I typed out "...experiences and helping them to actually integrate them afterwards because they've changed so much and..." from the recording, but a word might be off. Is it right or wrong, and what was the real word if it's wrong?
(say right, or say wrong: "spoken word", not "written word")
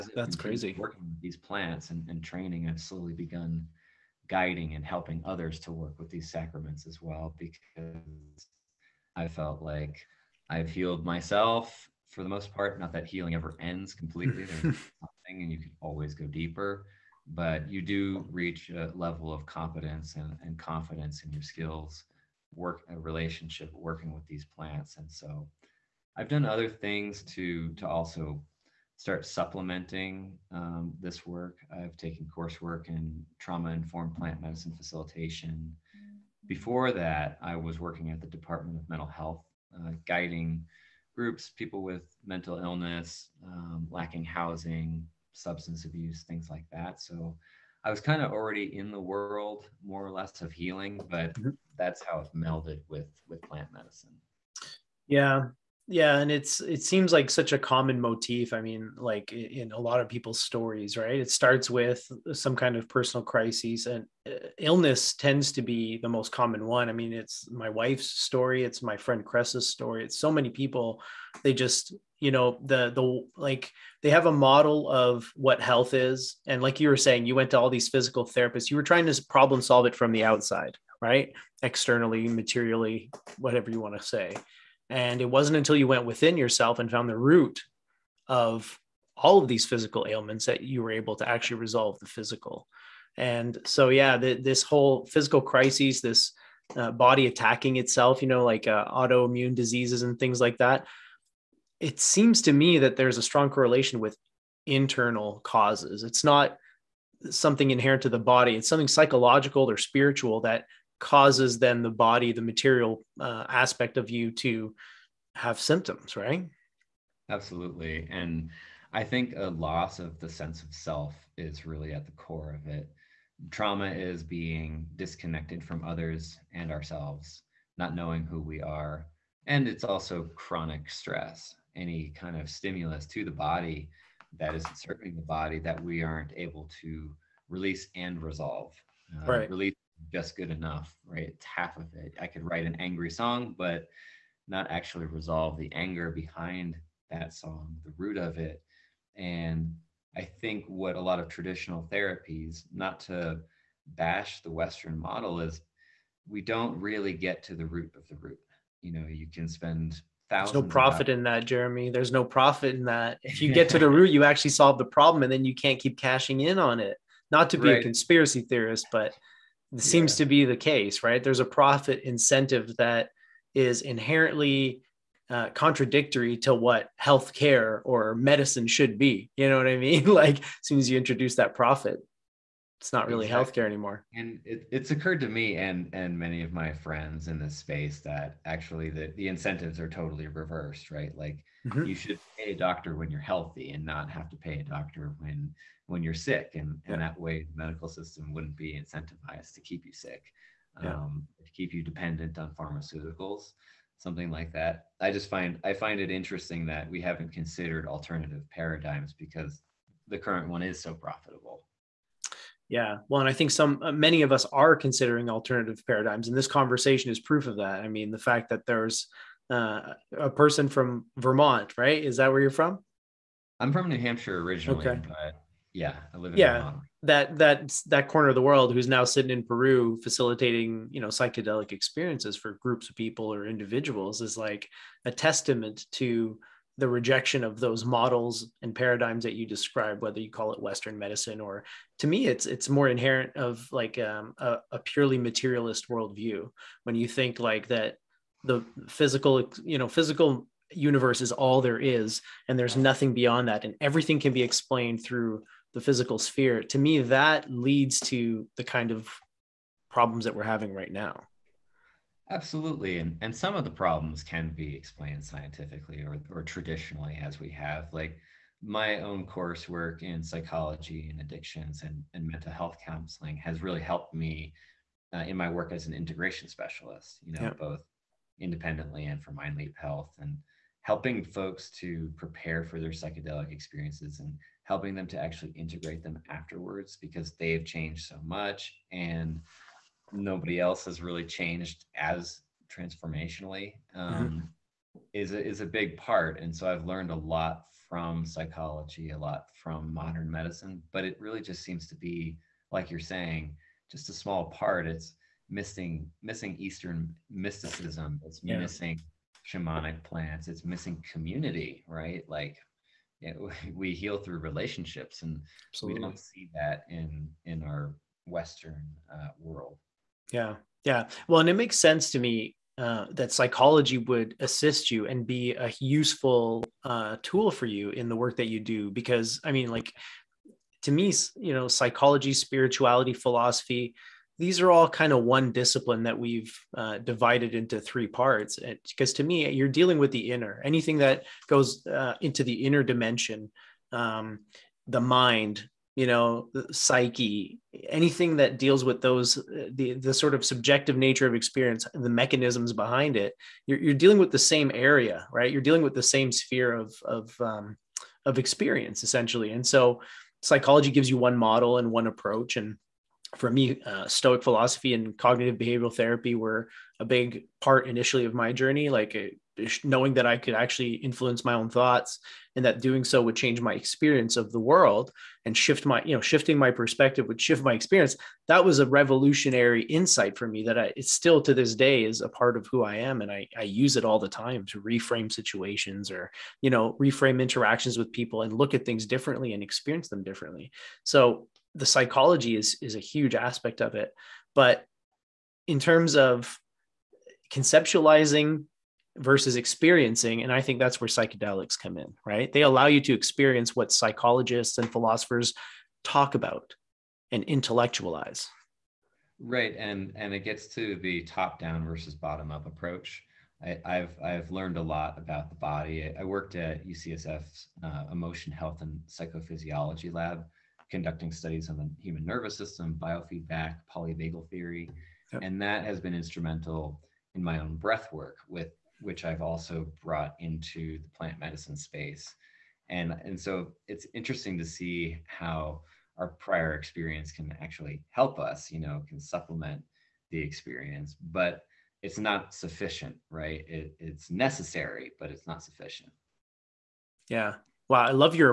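right.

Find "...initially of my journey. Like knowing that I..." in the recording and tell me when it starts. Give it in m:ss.
6:07.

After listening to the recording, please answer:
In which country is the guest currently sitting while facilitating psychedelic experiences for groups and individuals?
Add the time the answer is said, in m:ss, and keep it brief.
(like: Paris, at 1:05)
Peru, at 3:49.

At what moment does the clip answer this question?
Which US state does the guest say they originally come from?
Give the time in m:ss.
3:43.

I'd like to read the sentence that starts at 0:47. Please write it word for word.
So I was kind of already in the world more or less of healing, but mm-hmm.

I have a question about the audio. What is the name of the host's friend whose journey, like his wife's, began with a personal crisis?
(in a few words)
Cress.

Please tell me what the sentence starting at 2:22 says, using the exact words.
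I could write an angry song, but not actually resolve the anger behind that song, the root of it.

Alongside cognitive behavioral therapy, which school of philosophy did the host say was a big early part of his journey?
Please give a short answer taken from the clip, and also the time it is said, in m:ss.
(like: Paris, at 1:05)
Stoic philosophy, at 6:04.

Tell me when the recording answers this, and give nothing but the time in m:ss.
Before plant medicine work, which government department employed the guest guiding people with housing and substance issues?
0:38.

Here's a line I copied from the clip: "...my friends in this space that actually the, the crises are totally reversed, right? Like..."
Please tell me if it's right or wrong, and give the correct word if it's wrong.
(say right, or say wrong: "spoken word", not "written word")
wrong: "incentives", not "crises".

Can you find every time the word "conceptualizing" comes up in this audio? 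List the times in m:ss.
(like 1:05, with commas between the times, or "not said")
6:37.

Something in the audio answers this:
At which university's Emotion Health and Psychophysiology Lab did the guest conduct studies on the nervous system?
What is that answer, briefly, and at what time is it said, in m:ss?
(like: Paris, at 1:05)
UCSF, at 6:56.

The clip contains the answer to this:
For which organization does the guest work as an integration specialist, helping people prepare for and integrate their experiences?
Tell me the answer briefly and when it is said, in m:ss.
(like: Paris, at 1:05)
MindLeap Health, at 4:39.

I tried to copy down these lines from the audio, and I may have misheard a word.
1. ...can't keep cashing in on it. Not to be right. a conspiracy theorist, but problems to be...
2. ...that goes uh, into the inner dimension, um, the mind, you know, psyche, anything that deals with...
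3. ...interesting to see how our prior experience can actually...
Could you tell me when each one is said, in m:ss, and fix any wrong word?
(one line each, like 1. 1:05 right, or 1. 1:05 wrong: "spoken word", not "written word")
1. 2:45 wrong: "seems", not "problems"
2. 5:40 right
3. 7:14 right.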